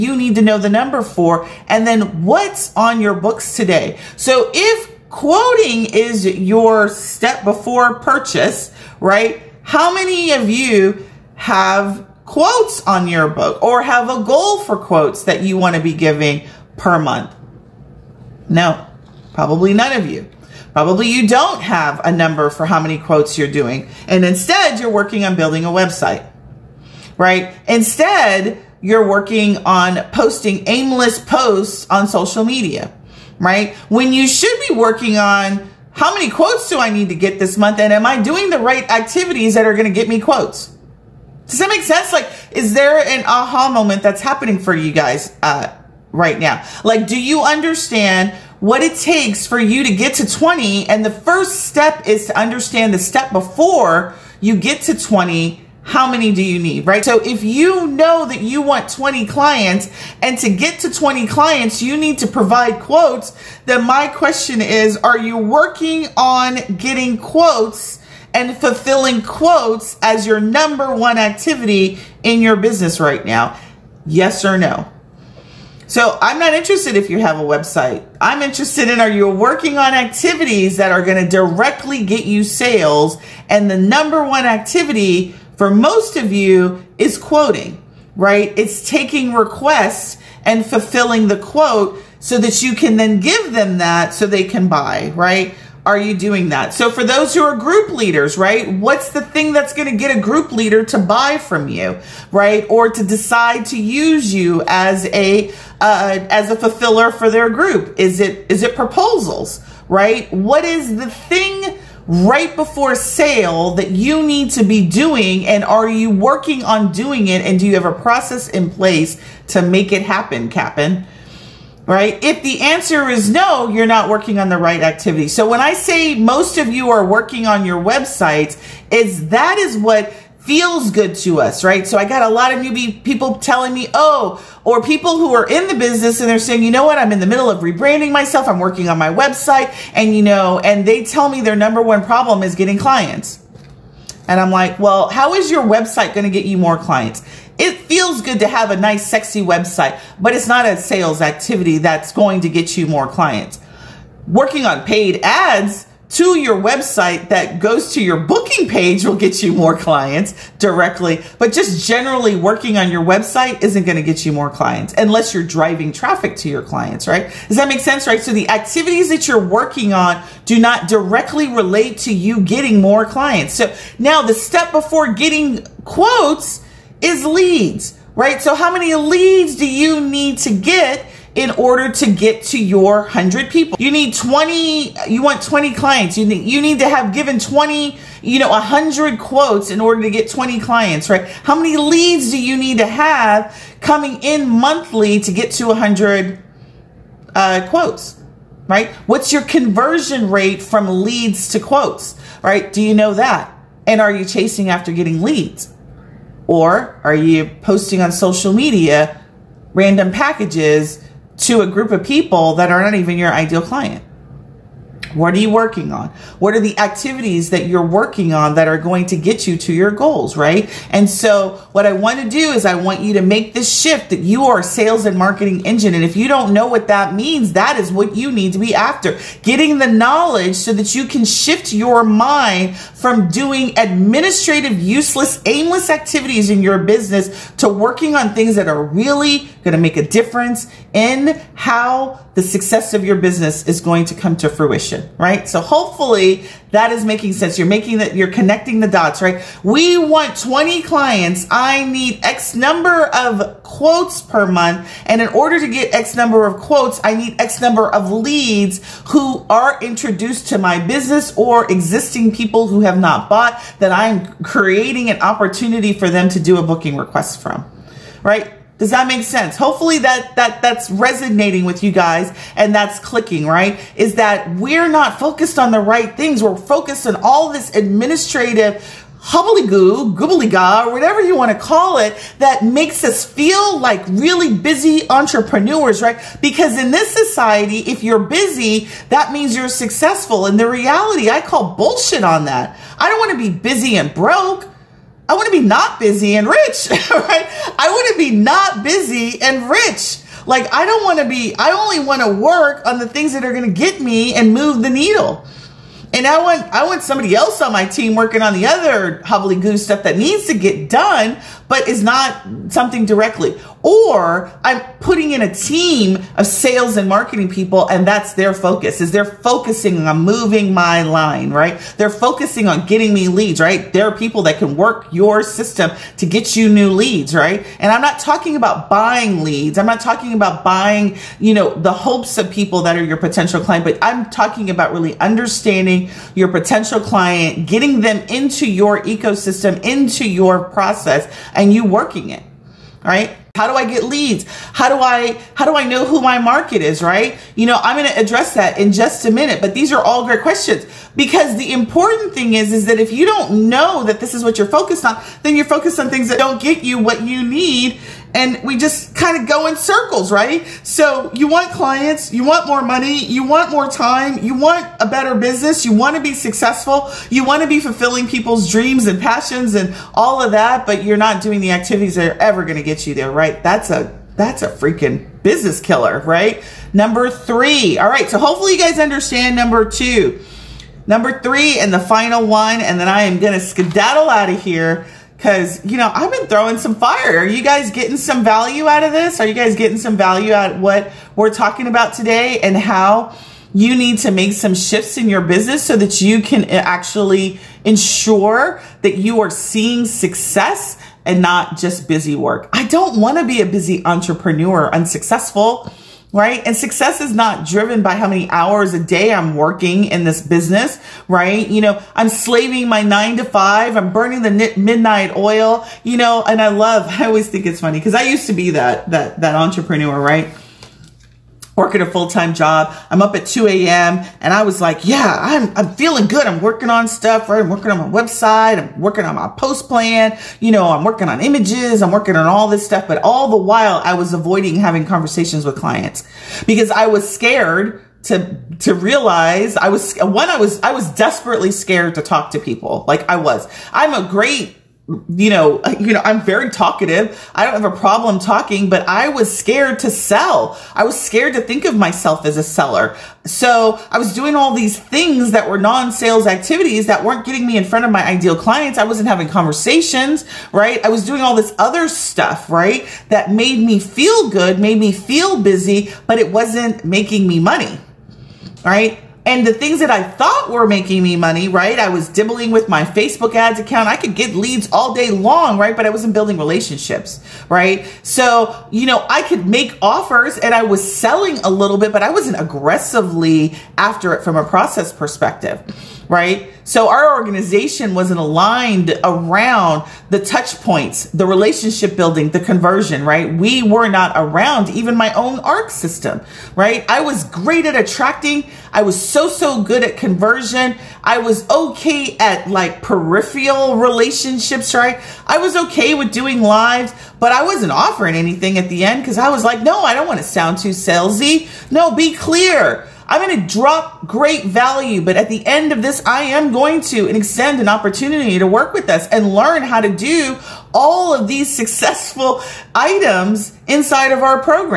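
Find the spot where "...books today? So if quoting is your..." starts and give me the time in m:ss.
0:03.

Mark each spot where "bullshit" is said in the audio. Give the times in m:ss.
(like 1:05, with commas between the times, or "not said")
4:51.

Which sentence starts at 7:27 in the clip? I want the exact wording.
I don't have a problem talking, but I was scared to sell.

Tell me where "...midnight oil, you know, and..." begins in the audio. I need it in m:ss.
6:54.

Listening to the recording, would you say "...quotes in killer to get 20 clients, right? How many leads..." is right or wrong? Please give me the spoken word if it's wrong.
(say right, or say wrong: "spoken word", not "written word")
wrong: "order", not "killer".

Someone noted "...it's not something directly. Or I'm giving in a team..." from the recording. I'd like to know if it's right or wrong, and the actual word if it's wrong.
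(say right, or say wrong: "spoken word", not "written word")
wrong: "putting", not "giving".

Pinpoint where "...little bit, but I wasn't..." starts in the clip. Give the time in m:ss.
8:01.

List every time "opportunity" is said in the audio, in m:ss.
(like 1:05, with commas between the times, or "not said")
4:25, 8:37.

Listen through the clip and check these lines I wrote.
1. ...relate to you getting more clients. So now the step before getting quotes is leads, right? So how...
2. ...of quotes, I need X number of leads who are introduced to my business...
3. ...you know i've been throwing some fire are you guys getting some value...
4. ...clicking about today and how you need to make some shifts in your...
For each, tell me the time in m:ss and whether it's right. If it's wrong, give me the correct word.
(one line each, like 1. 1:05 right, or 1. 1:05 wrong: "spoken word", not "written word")
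1. 2:51 right
2. 4:16 right
3. 6:25 right
4. 6:31 wrong: "talking", not "clicking".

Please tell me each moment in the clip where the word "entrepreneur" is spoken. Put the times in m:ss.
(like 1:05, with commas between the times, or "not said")
4:45, 6:44, 6:59.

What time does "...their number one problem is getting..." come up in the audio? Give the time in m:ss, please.
2:21.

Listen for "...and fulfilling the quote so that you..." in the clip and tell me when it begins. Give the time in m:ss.
1:30.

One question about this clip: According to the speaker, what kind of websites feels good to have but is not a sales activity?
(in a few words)
Sexy website.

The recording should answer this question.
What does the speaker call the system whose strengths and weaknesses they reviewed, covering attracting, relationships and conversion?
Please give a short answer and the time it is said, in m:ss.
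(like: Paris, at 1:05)
ARC system, at 8:15.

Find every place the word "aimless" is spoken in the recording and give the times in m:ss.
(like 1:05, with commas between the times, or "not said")
0:30, 3:55.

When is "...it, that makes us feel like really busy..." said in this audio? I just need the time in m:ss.
4:41.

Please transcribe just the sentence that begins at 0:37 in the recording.
And am I doing the right activities that are going to get me quotes?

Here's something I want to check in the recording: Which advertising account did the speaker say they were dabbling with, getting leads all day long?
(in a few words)
Facebook ads.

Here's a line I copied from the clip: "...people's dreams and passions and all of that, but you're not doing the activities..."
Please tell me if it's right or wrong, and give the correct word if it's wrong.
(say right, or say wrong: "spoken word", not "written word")
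right.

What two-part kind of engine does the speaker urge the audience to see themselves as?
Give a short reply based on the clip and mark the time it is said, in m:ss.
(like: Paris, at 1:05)
Sales and marketing engine, at 3:44.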